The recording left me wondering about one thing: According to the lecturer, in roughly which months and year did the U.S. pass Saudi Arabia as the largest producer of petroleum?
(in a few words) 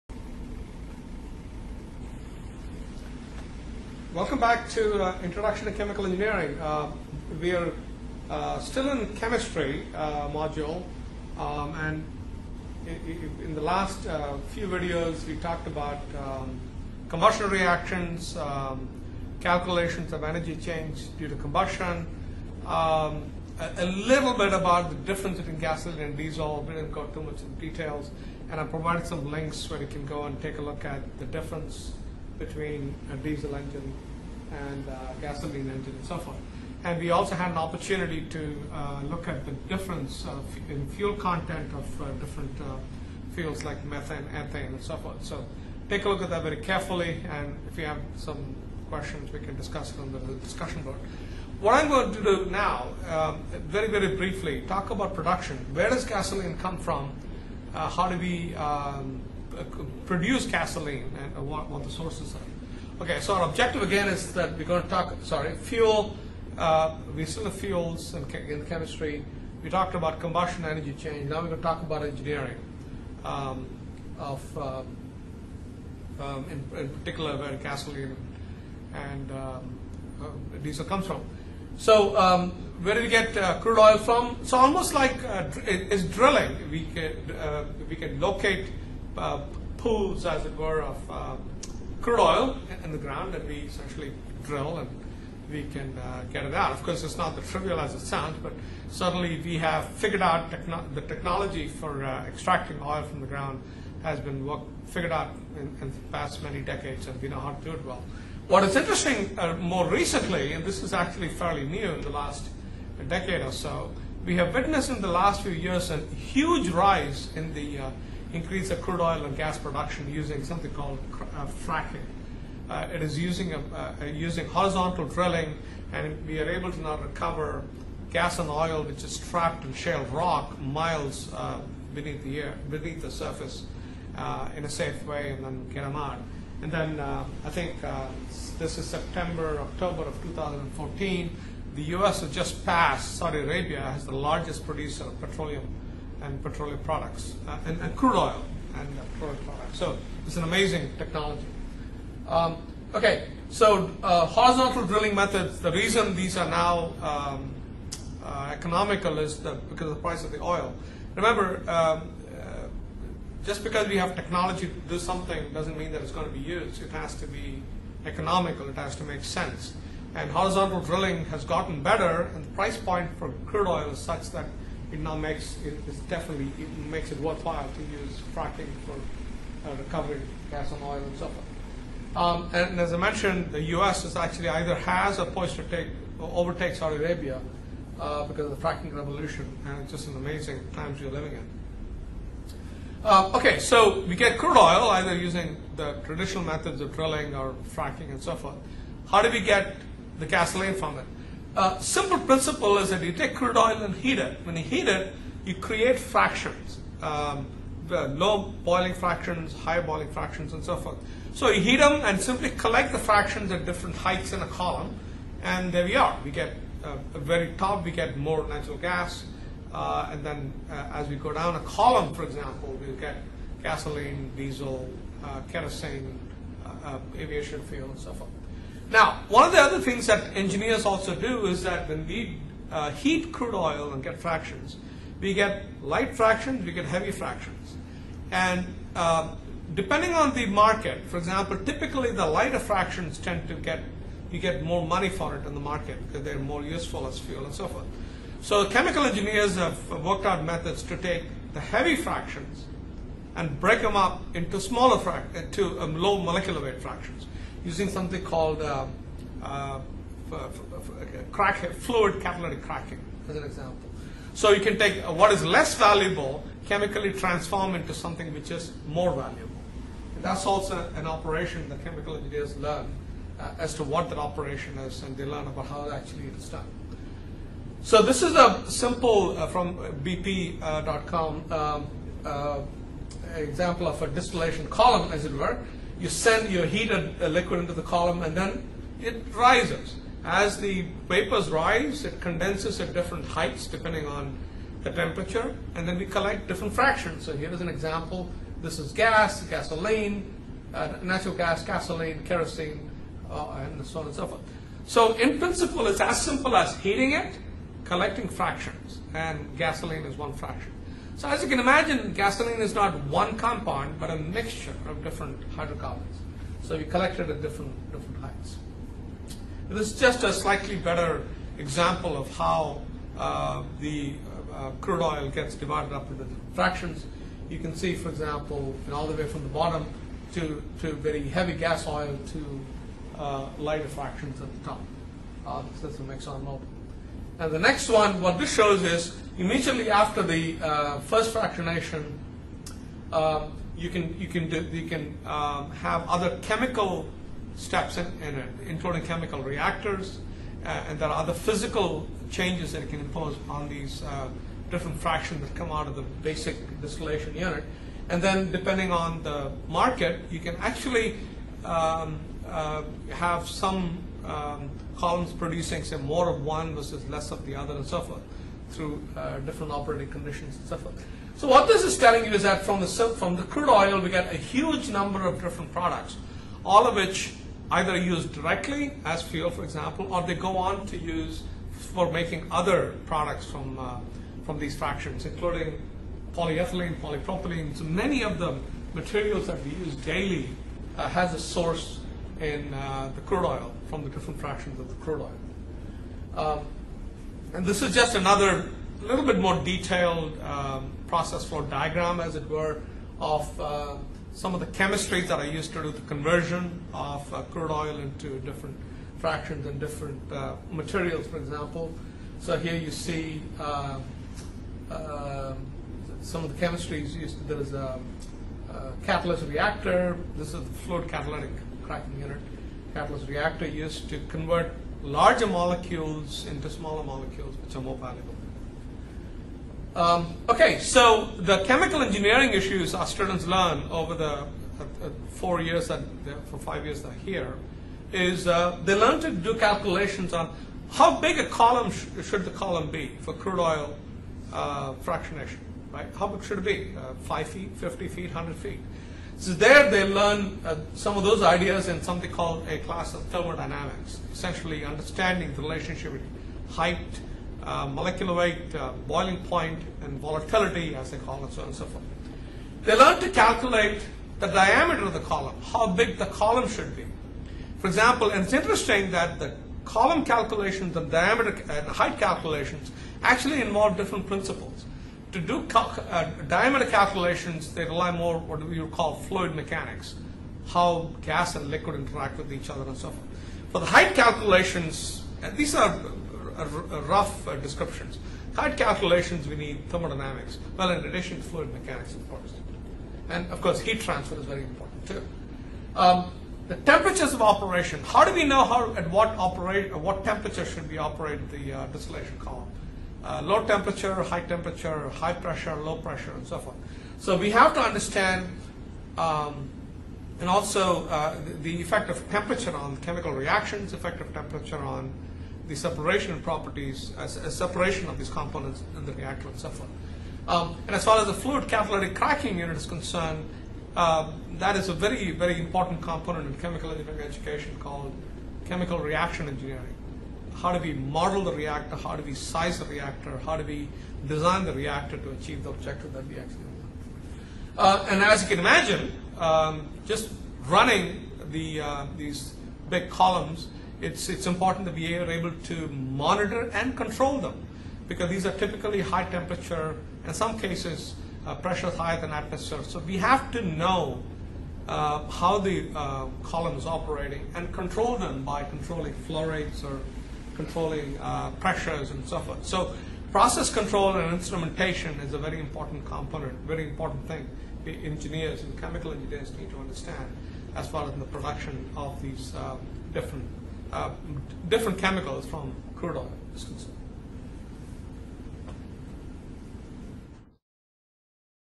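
September, October of 2014.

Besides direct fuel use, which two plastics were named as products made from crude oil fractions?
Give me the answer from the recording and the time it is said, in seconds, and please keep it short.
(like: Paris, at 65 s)
Polyethylene, polypropylene, at 386 s.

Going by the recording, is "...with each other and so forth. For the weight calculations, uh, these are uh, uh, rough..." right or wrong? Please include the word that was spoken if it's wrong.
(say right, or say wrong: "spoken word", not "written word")
wrong: "height", not "weight".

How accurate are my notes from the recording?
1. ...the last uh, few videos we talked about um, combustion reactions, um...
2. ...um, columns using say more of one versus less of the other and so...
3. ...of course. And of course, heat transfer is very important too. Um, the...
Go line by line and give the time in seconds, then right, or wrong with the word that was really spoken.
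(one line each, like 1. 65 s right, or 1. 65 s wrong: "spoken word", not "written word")
1. 13 s right
2. 364 s wrong: "producing", not "using"
3. 492 s right.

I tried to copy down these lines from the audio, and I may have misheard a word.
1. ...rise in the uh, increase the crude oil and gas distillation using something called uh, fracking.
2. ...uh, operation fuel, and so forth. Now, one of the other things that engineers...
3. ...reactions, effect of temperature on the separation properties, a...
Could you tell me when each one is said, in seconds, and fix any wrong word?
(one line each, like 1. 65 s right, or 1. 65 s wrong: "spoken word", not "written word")
1. 116 s wrong: "production", not "distillation"
2. 226 s wrong: "aviation", not "operation"
3. 513 s right.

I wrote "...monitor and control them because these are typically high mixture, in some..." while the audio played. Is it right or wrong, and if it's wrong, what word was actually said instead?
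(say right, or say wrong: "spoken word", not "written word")
wrong: "temperature", not "mixture".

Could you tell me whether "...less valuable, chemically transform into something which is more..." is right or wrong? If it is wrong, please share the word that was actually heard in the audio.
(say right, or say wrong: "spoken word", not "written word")
right.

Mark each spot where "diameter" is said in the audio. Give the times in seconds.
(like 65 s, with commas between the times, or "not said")
464 s, 471 s, 476 s.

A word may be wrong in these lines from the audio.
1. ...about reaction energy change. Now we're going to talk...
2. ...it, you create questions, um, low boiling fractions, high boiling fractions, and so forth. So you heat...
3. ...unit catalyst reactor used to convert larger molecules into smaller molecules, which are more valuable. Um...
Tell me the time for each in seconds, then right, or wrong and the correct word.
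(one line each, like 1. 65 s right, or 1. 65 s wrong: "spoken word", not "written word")
1. 69 s wrong: "combustion", not "reaction"
2. 204 s wrong: "fractions", not "questions"
3. 422 s right.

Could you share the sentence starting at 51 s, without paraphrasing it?
What I'm going to do now, um, very, very briefly, talk about production.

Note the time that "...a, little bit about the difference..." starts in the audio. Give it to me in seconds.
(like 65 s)
23 s.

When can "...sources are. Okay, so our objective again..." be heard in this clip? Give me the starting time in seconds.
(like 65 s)
61 s.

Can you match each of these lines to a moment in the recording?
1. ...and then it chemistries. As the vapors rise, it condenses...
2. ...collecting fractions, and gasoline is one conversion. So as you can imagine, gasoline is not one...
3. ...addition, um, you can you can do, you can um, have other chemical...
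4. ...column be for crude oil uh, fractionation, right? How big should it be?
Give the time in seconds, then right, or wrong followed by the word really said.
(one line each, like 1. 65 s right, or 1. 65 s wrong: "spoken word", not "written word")
1. 288 s wrong: "rises", not "chemistries"
2. 307 s wrong: "fraction", not "conversion"
3. 341 s wrong: "fractionation", not "addition"
4. 442 s right.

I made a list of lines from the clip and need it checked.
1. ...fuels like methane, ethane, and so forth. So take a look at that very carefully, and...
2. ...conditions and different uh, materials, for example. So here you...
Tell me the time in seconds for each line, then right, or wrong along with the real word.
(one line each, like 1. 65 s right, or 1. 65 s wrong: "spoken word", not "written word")
1. 43 s right
2. 409 s wrong: "fractions", not "conditions".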